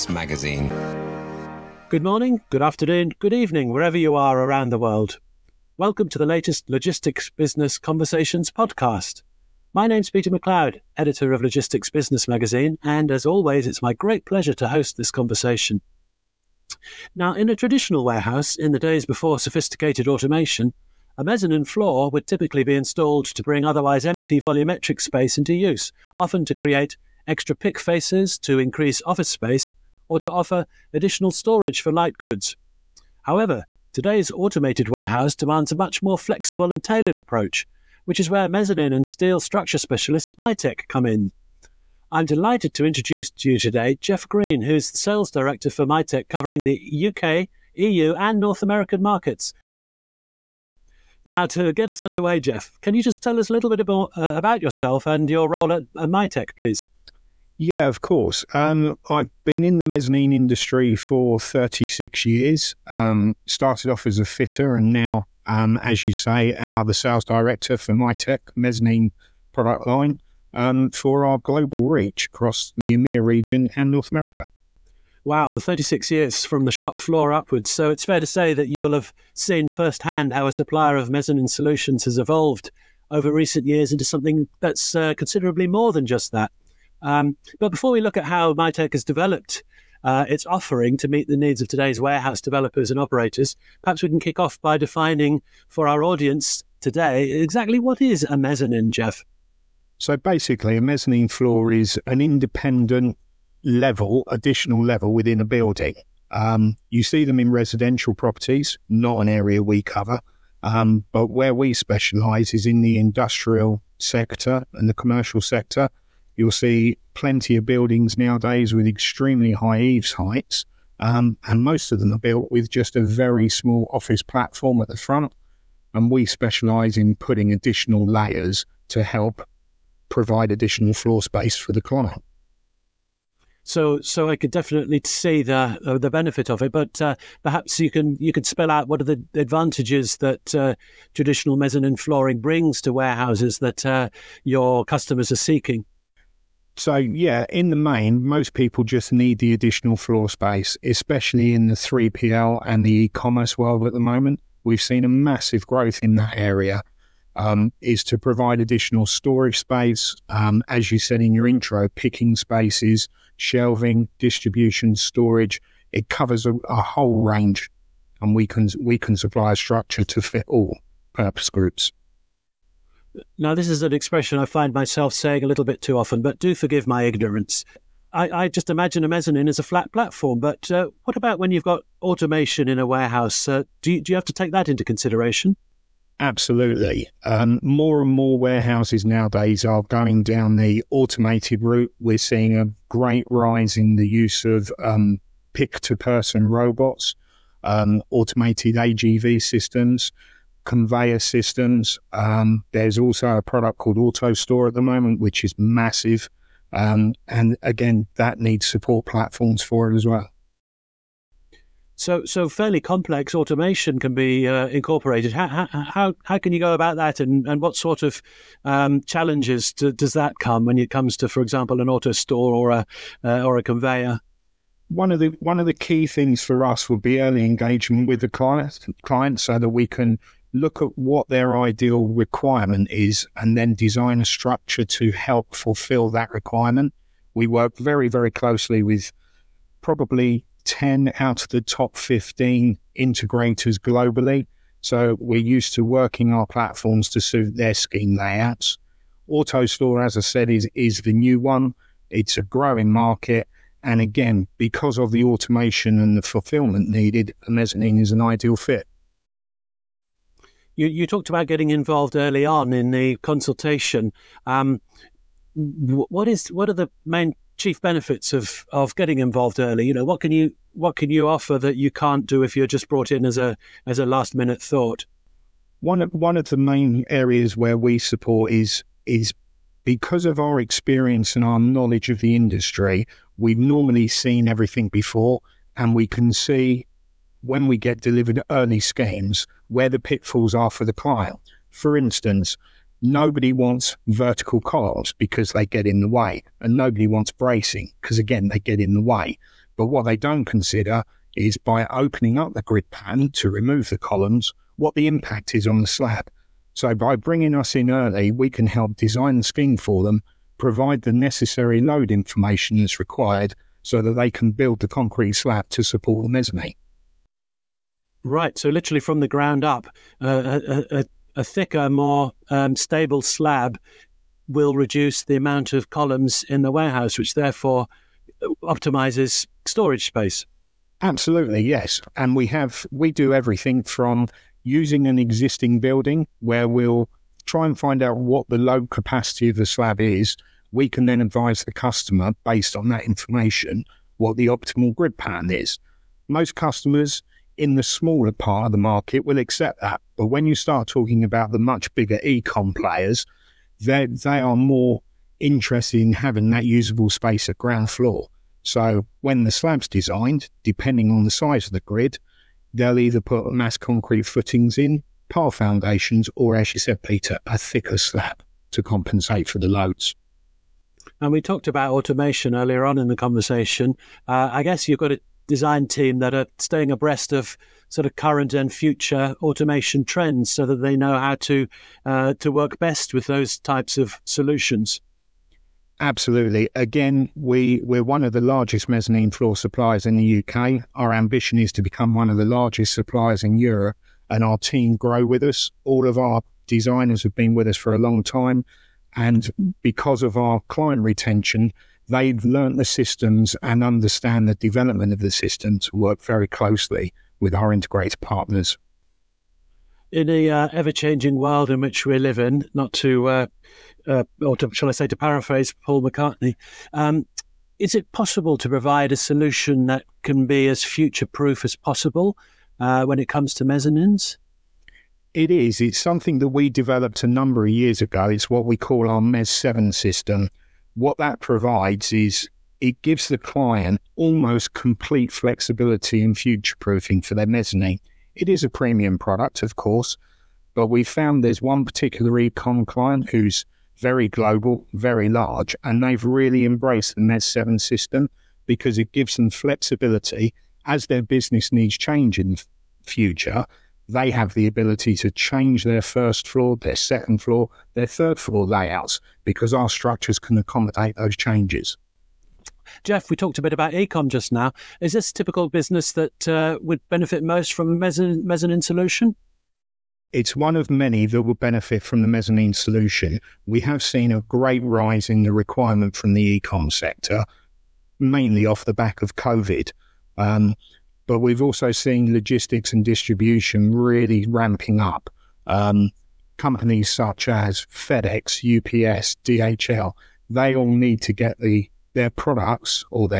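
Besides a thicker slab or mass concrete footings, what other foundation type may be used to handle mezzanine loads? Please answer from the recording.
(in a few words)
Pile foundations.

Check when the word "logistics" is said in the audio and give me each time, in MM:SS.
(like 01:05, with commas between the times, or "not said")
00:06, 00:11, 08:02.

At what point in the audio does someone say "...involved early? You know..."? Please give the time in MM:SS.
04:29.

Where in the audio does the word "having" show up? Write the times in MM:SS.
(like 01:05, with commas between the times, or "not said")
05:56.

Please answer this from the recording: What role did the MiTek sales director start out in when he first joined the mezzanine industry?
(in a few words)
Fitter.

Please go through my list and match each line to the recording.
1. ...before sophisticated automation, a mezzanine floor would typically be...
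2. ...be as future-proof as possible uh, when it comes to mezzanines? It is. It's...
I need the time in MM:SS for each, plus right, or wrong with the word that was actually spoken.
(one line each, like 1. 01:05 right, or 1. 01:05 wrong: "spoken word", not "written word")
1. 00:19 right
2. 07:00 right.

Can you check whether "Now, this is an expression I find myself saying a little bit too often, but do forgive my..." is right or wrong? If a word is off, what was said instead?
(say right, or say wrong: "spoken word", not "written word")
right.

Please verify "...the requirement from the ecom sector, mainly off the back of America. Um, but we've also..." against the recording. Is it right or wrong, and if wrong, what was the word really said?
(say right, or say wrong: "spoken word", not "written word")
wrong: "COVID", not "America".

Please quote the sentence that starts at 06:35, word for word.
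All of our designers have been with us for a long time.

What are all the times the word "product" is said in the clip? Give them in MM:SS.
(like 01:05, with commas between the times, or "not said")
01:09, 03:23, 07:19, 08:12.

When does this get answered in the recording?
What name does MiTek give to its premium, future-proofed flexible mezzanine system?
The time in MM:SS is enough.
07:09.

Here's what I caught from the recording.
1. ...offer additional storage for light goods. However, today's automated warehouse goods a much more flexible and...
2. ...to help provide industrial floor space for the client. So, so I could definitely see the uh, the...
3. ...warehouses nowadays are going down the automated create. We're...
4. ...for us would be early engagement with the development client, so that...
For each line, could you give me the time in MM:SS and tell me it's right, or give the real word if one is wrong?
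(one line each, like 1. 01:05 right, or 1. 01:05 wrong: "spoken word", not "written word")
1. 00:30 wrong: "demands", not "goods"
2. 02:08 wrong: "additional", not "industrial"
3. 03:08 wrong: "route", not "create"
4. 03:46 wrong: "client", not "development".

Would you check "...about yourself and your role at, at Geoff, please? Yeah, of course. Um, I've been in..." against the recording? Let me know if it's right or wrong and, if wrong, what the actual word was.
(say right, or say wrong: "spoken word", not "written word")
wrong: "MiTek", not "Geoff".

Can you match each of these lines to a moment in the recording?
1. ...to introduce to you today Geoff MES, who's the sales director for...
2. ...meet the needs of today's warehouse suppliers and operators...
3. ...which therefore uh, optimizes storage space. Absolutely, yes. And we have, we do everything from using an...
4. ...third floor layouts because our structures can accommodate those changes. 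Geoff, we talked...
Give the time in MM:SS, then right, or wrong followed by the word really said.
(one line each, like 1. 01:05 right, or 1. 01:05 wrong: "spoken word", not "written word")
1. 00:42 wrong: "Green", not "MES"
2. 01:31 wrong: "developers", not "suppliers"
3. 05:27 right
4. 07:38 right.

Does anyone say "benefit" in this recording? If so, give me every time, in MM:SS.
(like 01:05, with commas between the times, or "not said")
02:16, 04:27, 07:47, 07:51.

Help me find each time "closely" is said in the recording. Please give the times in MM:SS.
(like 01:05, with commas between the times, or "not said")
03:58, 06:46.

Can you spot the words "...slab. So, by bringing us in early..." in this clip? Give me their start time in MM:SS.
05:05.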